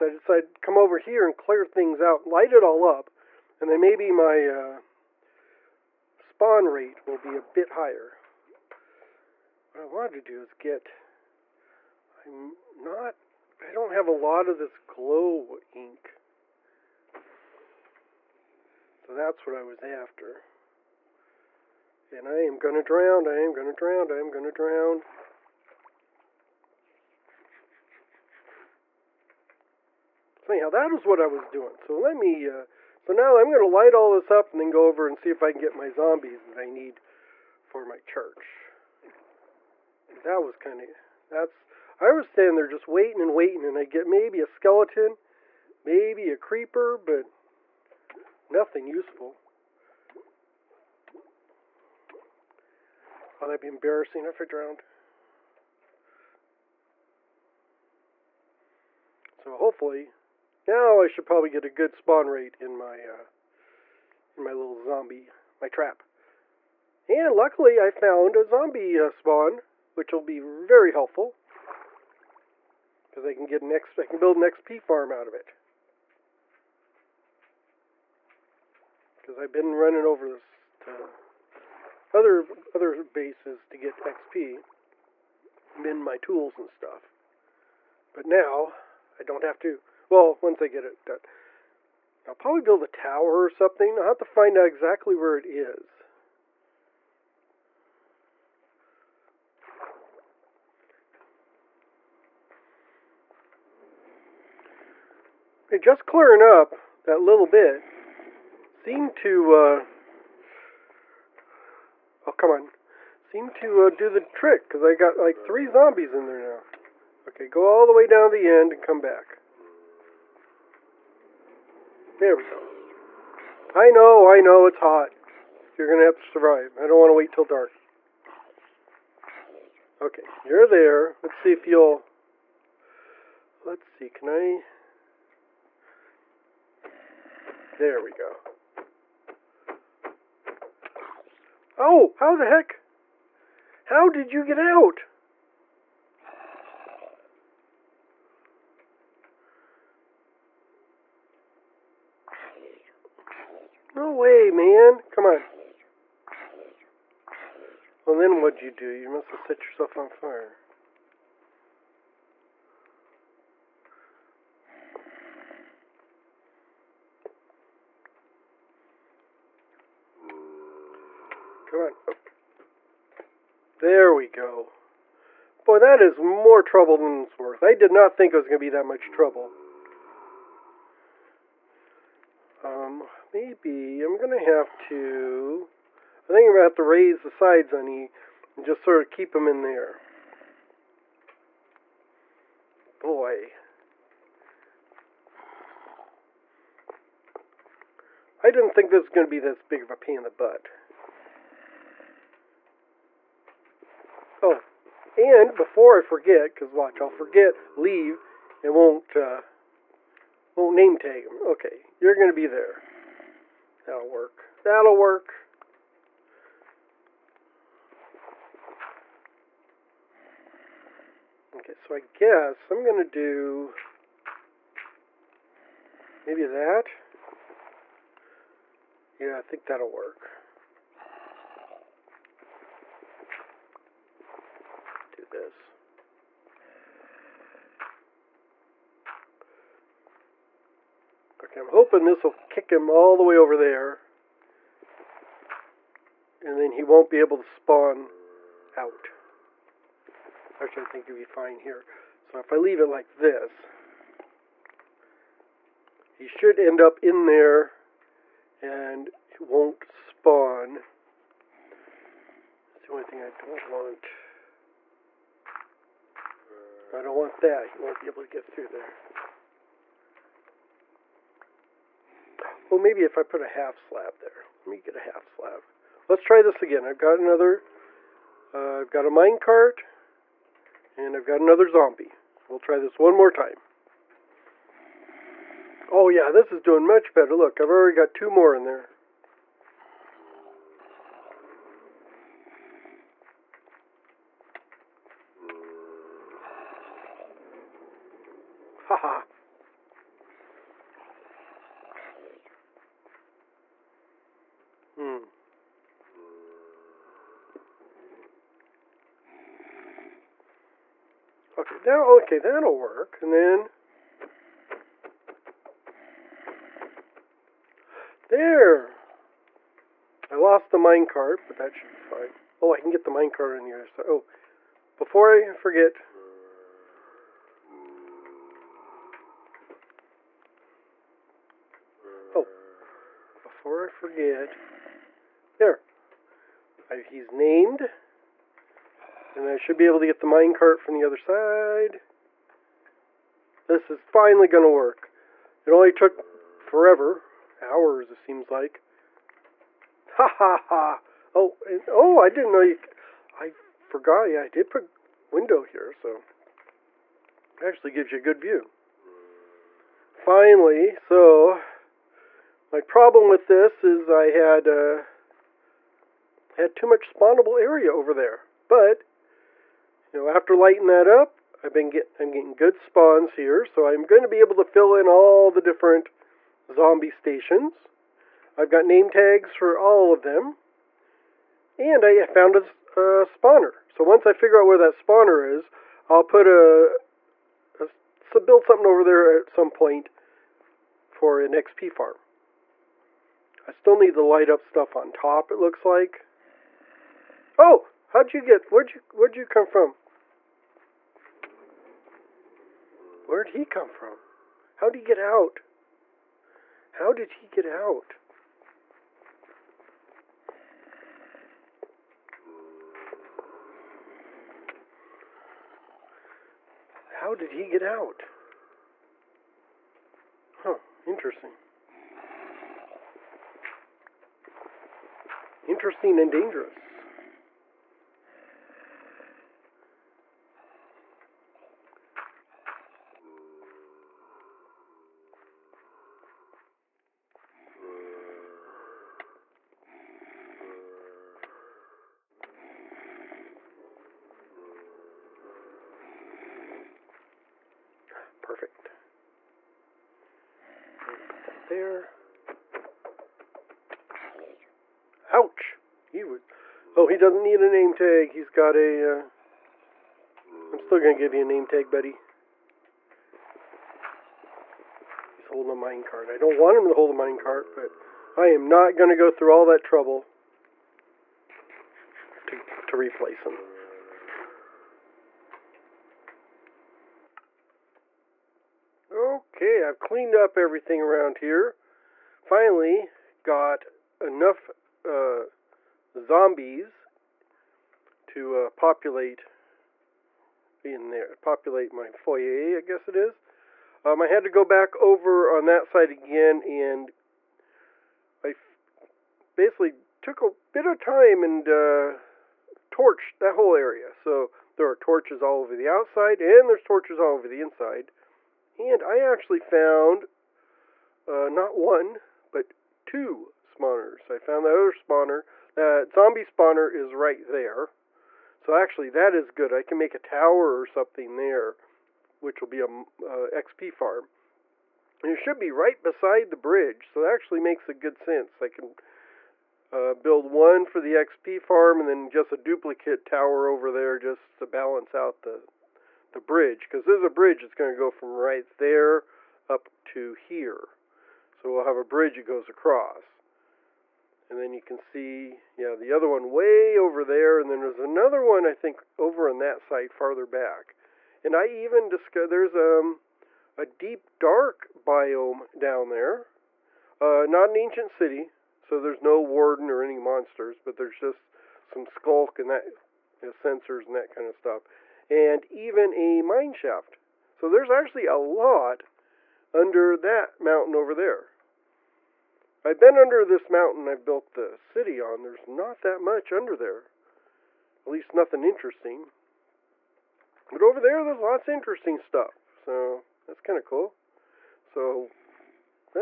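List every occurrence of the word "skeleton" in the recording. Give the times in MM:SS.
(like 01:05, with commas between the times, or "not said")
00:44.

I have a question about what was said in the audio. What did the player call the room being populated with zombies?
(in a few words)
foyer.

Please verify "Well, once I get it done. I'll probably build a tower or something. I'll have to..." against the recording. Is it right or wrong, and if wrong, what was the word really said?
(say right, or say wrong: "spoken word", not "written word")
right.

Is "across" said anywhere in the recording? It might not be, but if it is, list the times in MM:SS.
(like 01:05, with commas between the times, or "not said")
09:02.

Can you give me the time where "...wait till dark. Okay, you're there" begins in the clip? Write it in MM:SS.
02:07.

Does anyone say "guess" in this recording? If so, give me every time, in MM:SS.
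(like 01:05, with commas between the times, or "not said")
03:41, 08:12.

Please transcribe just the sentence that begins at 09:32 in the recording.
I've been under this mountain I've built the city on.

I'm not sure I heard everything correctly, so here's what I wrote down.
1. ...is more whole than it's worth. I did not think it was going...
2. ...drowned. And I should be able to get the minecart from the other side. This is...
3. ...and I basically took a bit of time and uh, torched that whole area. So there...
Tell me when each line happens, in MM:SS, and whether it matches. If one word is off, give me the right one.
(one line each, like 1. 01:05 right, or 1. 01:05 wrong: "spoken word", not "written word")
1. 02:56 wrong: "trouble", not "whole"
2. 05:37 wrong: "named", not "drowned"
3. 08:16 right.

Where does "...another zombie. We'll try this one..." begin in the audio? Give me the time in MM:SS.
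04:41.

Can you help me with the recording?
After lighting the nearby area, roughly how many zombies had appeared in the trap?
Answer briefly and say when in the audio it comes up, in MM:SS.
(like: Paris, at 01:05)
3, at 01:55.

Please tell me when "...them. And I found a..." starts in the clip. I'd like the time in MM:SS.
06:20.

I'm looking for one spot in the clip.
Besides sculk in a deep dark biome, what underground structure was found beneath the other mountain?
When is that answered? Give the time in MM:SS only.
09:26.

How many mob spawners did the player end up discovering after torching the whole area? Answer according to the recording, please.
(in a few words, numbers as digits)
2.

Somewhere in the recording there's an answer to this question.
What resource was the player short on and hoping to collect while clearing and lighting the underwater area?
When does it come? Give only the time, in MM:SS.
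00:14.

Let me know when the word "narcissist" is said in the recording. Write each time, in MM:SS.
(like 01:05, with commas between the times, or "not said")
not said.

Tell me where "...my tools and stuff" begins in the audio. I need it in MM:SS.
01:25.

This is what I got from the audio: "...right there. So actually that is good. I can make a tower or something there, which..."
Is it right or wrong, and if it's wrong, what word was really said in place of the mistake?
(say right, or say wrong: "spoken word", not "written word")
right.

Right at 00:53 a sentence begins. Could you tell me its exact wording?
Oh, that'd be embarrassing if I drowned.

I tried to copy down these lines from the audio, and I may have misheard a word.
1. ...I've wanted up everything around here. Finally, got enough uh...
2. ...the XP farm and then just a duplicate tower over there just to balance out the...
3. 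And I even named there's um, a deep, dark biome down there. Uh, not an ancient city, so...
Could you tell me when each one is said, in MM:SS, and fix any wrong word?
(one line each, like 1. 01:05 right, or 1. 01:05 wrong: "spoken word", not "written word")
1. 07:59 wrong: "cleaned", not "wanted"
2. 08:51 right
3. 09:11 wrong: "discovered", not "named".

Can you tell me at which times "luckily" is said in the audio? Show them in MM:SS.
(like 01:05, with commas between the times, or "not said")
01:07.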